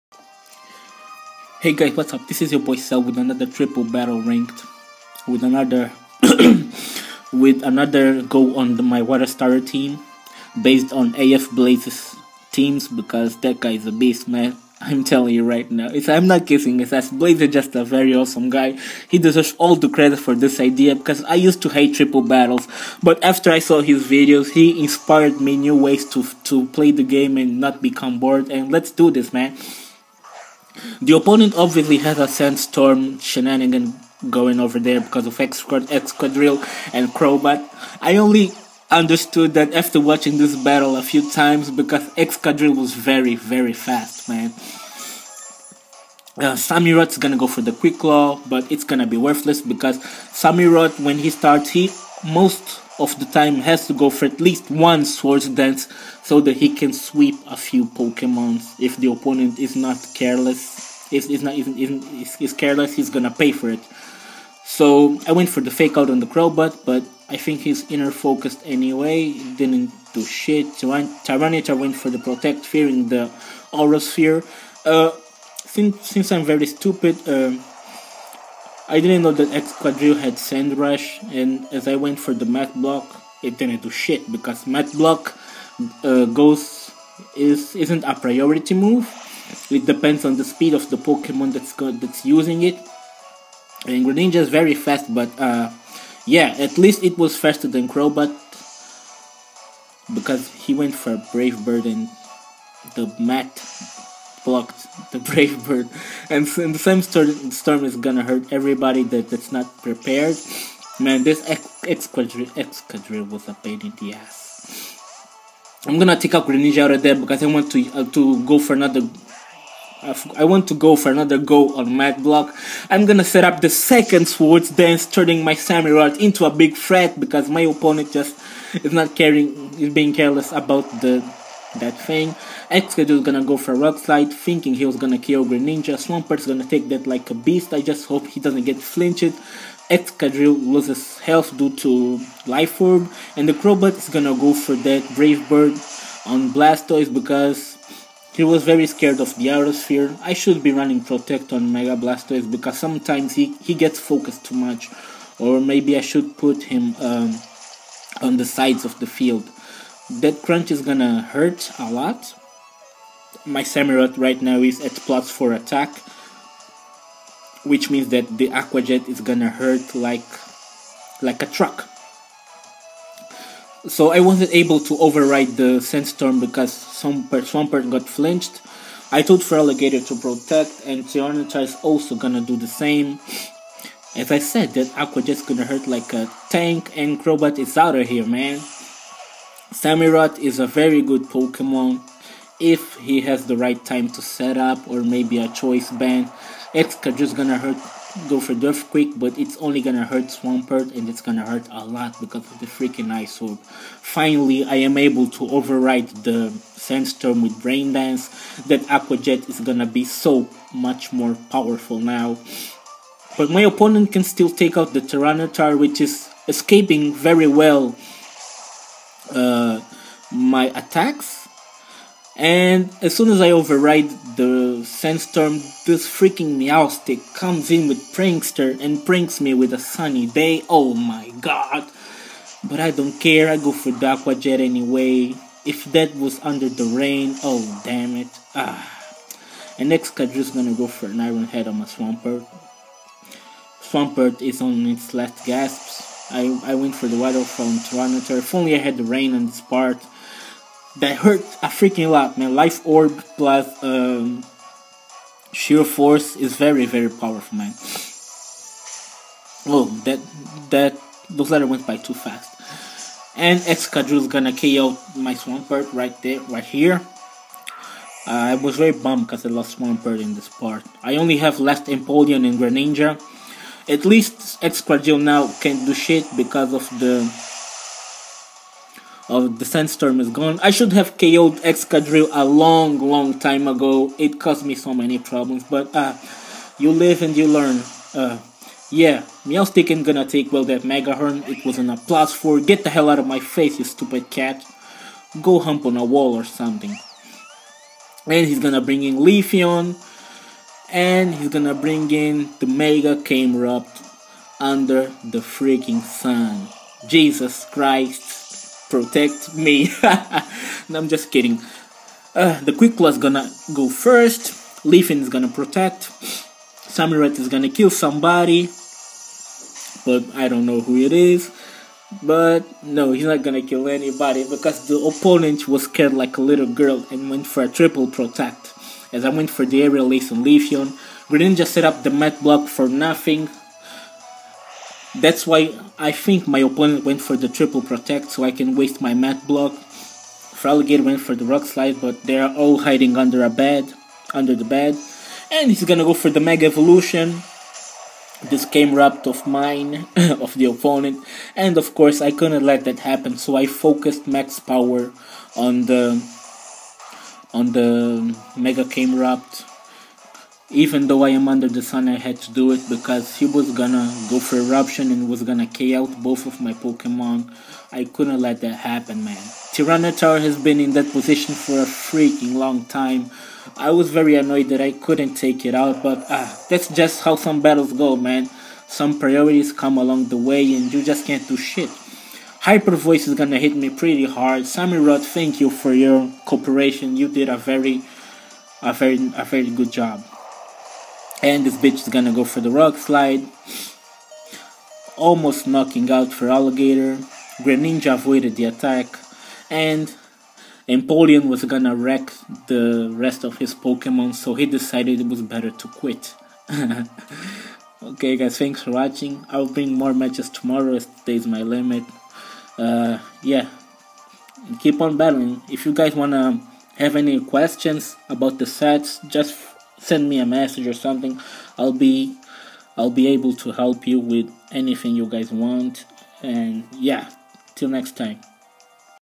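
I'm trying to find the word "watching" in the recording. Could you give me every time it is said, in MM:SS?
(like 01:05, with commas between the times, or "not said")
00:39, 06:48.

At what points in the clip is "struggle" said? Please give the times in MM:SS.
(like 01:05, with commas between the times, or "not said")
not said.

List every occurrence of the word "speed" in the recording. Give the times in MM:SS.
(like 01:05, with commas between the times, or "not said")
01:30.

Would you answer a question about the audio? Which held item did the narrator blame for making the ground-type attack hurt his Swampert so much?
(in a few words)
Ice Orb.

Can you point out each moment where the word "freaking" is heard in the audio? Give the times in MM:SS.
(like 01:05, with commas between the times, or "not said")
03:22, 03:46, 04:11, 05:05, 06:11.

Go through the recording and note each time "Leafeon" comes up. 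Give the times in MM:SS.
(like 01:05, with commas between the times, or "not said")
04:59, 05:14, 05:30.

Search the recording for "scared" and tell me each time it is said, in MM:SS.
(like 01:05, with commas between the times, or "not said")
02:28, 05:25.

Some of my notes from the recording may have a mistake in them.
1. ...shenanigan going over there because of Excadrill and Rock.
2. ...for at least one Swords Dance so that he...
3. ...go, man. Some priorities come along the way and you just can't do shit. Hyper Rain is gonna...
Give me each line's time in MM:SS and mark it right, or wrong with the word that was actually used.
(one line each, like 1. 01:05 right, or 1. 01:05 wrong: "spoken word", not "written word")
1. 00:33 wrong: "Crobat", not "Rock"
2. 00:54 right
3. 06:17 wrong: "Voice", not "Rain".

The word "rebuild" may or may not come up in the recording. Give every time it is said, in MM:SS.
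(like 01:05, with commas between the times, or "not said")
not said.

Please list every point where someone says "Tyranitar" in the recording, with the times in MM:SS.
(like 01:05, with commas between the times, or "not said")
01:10, 03:01, 03:34, 06:09.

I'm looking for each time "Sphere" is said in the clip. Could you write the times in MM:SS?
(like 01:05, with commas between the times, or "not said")
01:13, 02:29.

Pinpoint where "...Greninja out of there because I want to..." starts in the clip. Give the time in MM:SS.
01:56.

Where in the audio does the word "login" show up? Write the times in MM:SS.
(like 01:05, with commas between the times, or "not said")
not said.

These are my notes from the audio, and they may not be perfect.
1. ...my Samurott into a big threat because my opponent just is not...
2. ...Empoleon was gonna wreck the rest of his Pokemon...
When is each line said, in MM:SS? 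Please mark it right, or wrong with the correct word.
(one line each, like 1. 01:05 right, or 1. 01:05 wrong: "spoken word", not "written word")
1. 02:05 right
2. 06:40 right.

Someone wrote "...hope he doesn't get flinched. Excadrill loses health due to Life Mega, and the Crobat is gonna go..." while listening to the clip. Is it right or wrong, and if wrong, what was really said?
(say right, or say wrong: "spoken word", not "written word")
wrong: "Orb", not "Mega".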